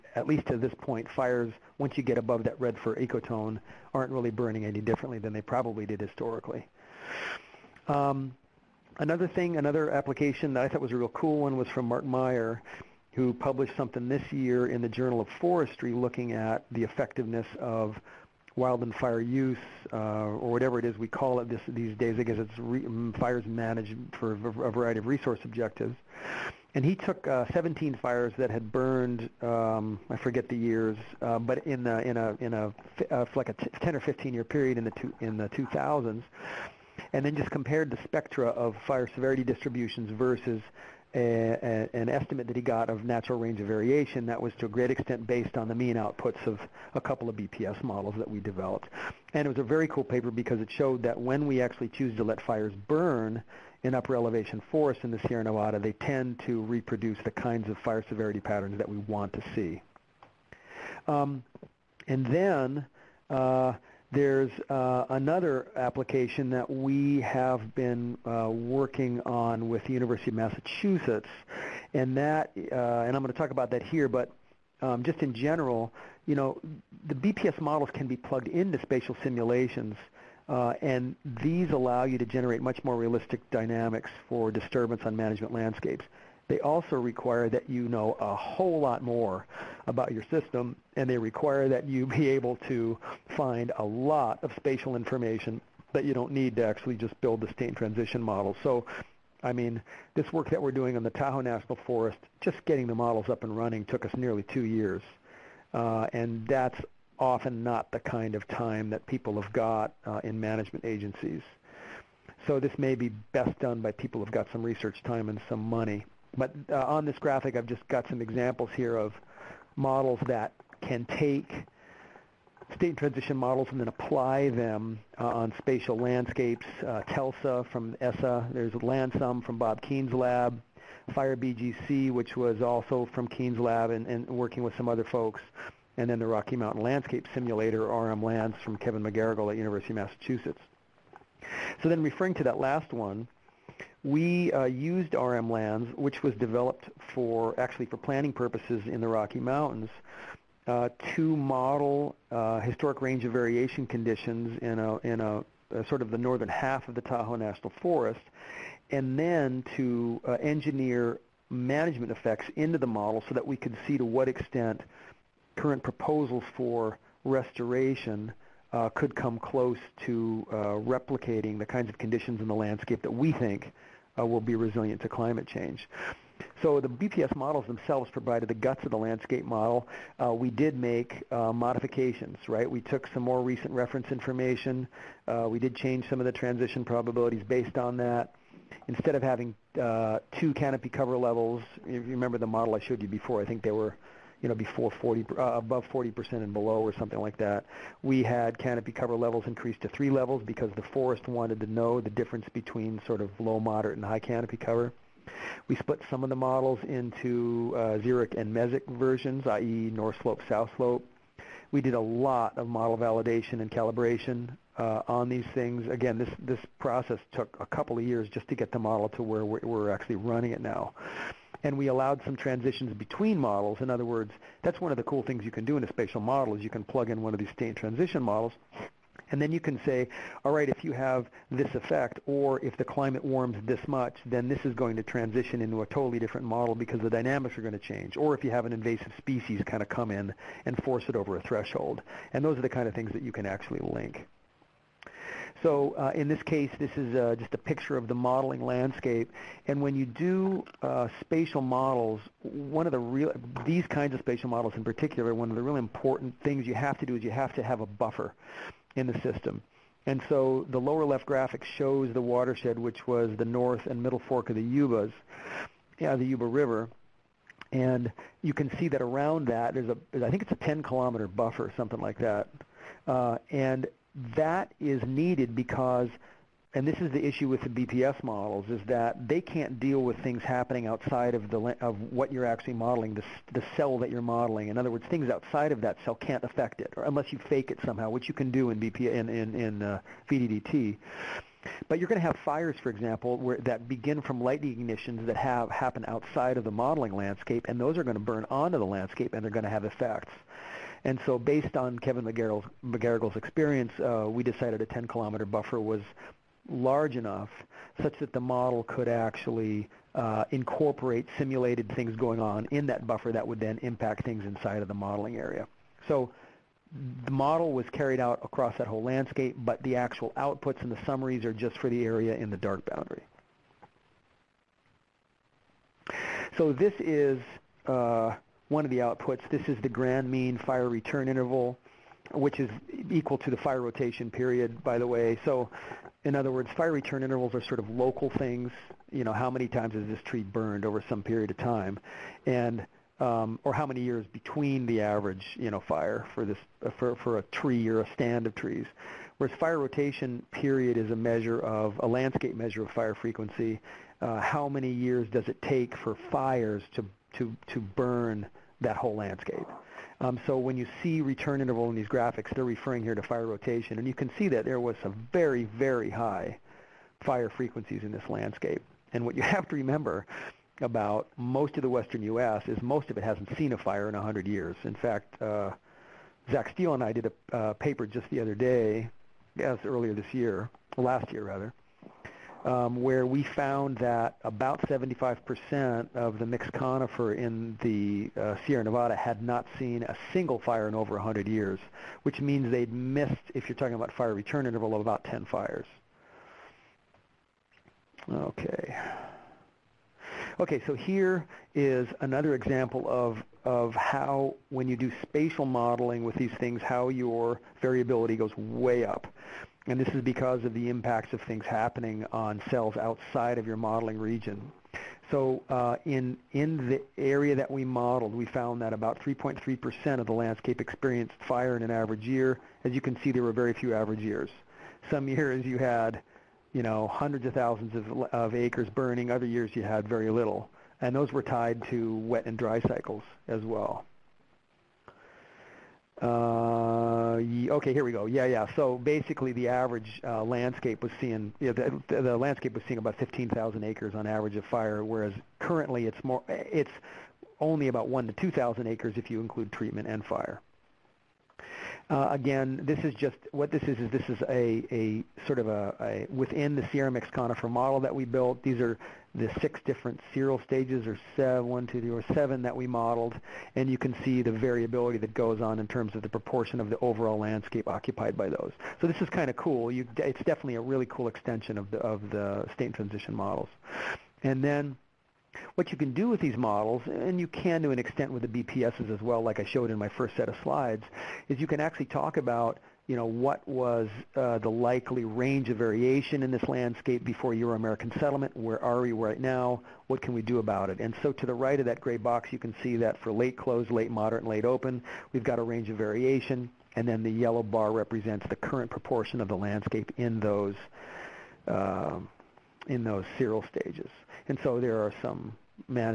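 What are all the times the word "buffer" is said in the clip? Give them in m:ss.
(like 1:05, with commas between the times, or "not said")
4:17, 4:31, 5:05, 5:13.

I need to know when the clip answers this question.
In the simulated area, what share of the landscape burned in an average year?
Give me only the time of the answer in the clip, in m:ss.
6:59.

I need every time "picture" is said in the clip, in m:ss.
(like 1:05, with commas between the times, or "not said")
4:07.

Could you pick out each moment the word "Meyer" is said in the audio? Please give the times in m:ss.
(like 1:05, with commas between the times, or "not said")
0:12.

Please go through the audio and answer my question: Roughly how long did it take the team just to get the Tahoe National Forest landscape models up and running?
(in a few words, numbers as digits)
nearly two years.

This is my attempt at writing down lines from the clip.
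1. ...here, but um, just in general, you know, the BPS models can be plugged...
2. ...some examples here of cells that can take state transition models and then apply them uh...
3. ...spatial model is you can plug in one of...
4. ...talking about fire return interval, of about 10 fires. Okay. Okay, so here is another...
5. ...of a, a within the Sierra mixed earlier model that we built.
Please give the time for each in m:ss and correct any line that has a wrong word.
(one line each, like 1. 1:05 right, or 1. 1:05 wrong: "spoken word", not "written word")
1. 1:13 right
2. 1:58 wrong: "models", not "cells"
3. 3:45 right
4. 6:33 right
5. 7:35 wrong: "conifer", not "earlier".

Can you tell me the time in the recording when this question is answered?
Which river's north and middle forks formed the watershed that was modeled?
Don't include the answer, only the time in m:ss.
4:26.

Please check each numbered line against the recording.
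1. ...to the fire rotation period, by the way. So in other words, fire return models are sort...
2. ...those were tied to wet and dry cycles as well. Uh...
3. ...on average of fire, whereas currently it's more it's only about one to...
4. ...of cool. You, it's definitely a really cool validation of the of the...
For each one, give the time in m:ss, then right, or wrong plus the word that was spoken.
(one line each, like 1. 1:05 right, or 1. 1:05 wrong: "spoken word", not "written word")
1. 5:33 wrong: "intervals", not "models"
2. 7:11 right
3. 7:24 right
4. 7:49 wrong: "extension", not "validation".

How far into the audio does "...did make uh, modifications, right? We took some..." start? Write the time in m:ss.
3:00.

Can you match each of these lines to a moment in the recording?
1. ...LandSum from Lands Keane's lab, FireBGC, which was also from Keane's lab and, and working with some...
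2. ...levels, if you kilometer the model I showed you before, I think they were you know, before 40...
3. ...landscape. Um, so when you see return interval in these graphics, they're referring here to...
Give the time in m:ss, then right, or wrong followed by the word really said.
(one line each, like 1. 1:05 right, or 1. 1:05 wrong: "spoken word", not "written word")
1. 2:08 wrong: "Bob", not "Lands"
2. 3:11 wrong: "remember", not "kilometer"
3. 5:59 right.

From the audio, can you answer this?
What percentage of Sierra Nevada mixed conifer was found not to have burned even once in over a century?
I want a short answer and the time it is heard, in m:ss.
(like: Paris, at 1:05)
75%, at 6:24.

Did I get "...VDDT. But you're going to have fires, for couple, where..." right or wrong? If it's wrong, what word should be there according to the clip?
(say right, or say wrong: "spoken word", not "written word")
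wrong: "example", not "couple".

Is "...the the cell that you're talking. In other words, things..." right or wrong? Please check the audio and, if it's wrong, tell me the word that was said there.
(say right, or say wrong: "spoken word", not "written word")
wrong: "modeling", not "talking".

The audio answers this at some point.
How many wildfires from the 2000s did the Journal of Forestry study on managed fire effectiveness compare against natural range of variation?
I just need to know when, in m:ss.
0:27.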